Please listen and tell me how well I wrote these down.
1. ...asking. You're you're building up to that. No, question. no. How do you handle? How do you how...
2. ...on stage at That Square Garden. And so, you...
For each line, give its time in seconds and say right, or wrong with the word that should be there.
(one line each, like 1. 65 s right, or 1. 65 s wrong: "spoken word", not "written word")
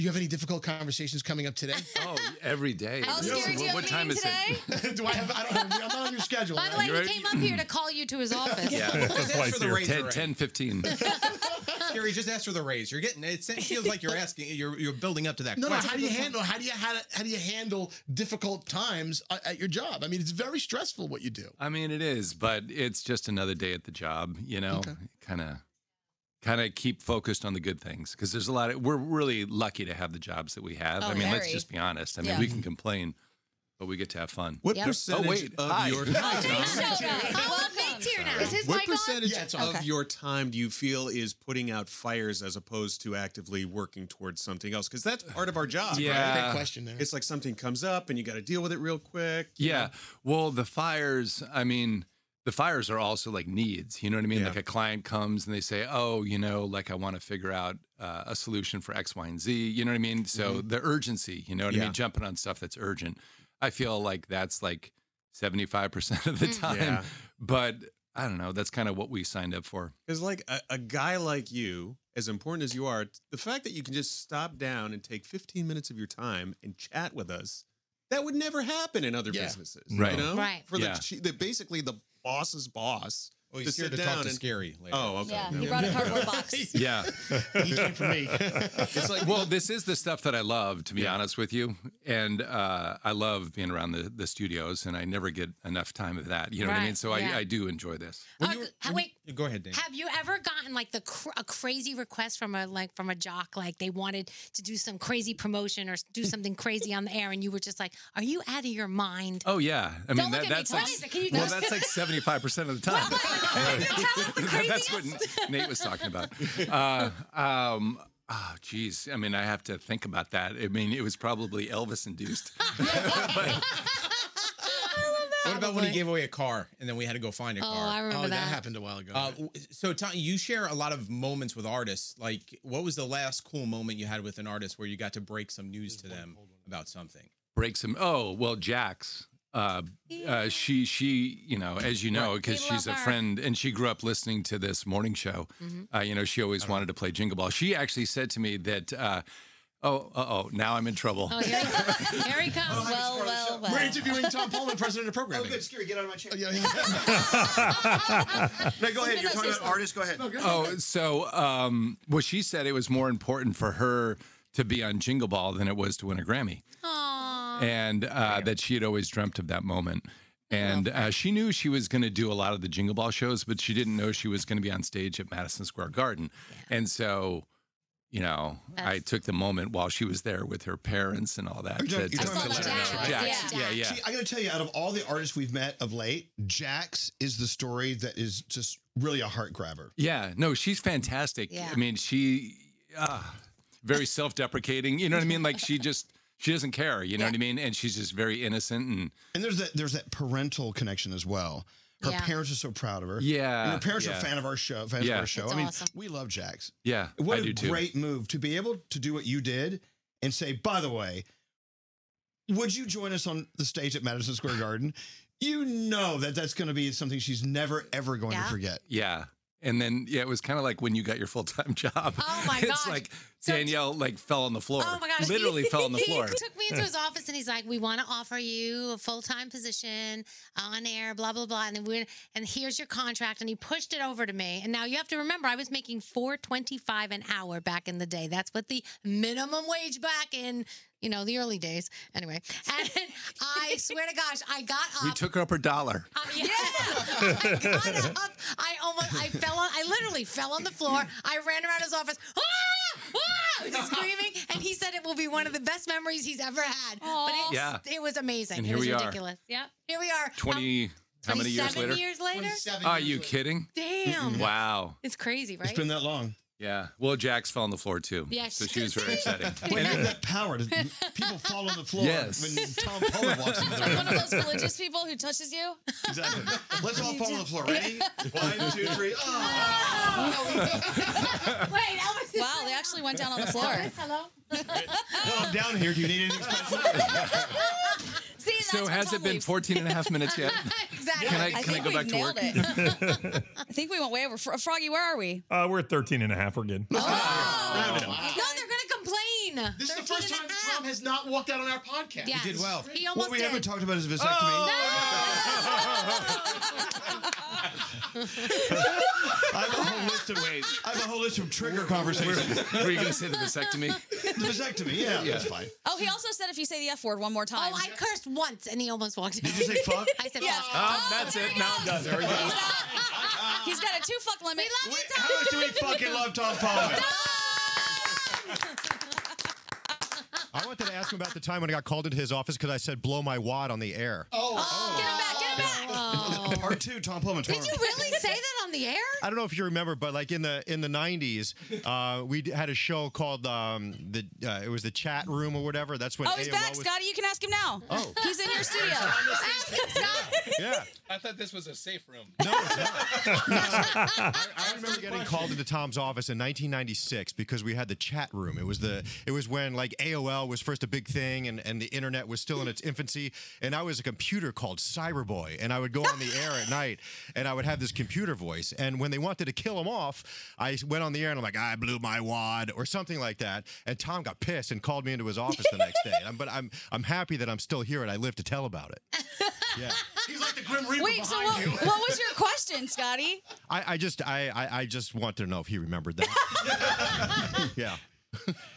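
1. 14 s right
2. 174 s wrong: "Madison", not "That".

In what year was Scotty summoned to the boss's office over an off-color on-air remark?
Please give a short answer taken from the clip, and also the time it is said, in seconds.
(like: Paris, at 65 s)
1996, at 356 s.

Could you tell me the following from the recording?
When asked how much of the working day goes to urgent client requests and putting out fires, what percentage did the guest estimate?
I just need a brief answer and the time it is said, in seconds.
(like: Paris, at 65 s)
75%, at 65 s.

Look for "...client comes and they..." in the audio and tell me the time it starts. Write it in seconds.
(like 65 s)
54 s.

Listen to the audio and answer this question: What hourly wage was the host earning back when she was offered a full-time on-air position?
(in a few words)
$4.25.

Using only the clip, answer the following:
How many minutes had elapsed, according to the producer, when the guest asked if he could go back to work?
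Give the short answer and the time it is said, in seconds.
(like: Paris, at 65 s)
13 and a half, at 295 s.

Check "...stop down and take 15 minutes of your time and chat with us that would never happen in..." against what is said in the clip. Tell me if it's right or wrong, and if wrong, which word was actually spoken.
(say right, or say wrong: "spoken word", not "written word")
right.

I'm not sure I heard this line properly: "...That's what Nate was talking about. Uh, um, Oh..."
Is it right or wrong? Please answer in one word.
right.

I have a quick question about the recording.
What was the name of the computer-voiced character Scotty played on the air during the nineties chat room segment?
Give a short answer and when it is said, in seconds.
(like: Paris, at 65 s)
Cyberboy, at 364 s.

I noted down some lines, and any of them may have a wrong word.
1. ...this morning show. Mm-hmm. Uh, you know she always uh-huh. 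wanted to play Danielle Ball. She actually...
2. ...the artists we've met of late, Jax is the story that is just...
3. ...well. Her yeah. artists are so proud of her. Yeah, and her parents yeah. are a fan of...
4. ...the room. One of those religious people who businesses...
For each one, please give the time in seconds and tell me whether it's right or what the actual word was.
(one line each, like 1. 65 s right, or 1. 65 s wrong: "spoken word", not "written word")
1. 144 s wrong: "Jingle", not "Danielle"
2. 184 s right
3. 201 s wrong: "parents", not "artists"
4. 273 s wrong: "touches", not "businesses".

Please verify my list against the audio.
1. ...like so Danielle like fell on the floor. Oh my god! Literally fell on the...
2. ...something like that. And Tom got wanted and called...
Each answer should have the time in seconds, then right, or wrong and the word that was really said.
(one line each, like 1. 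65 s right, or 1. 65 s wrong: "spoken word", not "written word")
1. 222 s right
2. 372 s wrong: "pissed", not "wanted".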